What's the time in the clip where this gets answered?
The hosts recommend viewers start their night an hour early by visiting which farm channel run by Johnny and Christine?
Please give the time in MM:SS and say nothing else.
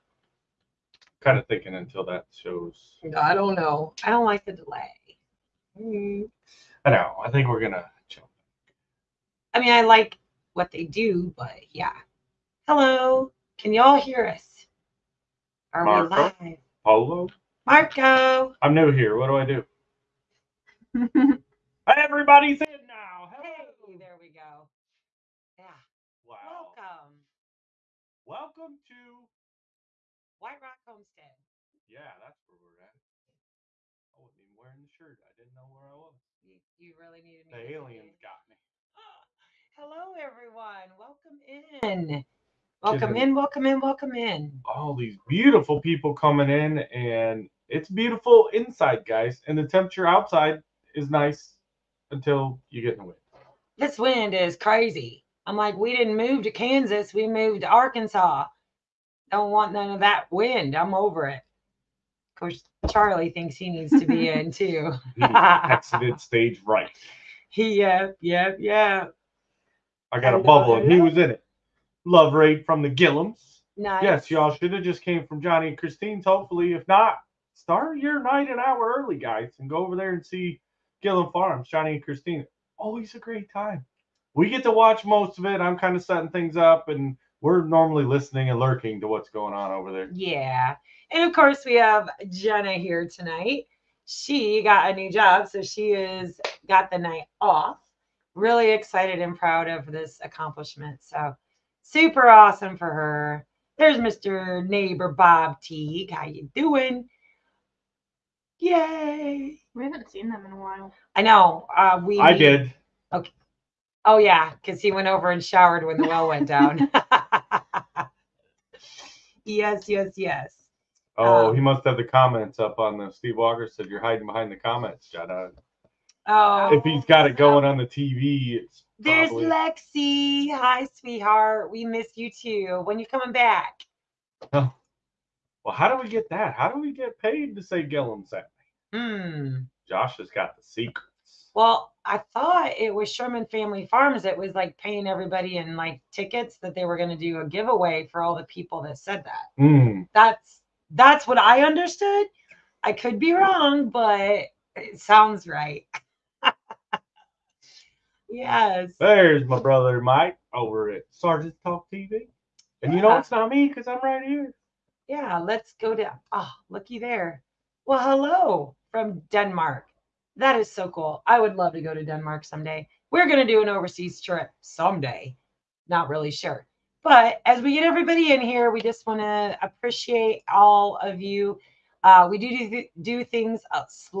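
01:21.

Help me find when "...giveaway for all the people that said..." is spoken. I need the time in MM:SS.
02:27.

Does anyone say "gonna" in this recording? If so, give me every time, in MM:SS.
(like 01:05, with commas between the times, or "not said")
00:07, 02:53.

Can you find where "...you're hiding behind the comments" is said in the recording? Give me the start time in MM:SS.
02:03.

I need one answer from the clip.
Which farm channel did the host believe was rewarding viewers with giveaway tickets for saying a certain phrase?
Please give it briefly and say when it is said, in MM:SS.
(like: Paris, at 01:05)
Sherman Family Farms, at 02:23.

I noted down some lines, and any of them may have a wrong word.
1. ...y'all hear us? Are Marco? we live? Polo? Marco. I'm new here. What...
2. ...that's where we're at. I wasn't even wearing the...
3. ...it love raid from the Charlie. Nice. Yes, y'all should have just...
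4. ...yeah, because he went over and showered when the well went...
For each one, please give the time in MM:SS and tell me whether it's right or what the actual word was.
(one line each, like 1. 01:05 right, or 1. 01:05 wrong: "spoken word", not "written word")
1. 00:13 right
2. 00:32 right
3. 01:11 wrong: "Gillums", not "Charlie"
4. 01:54 right.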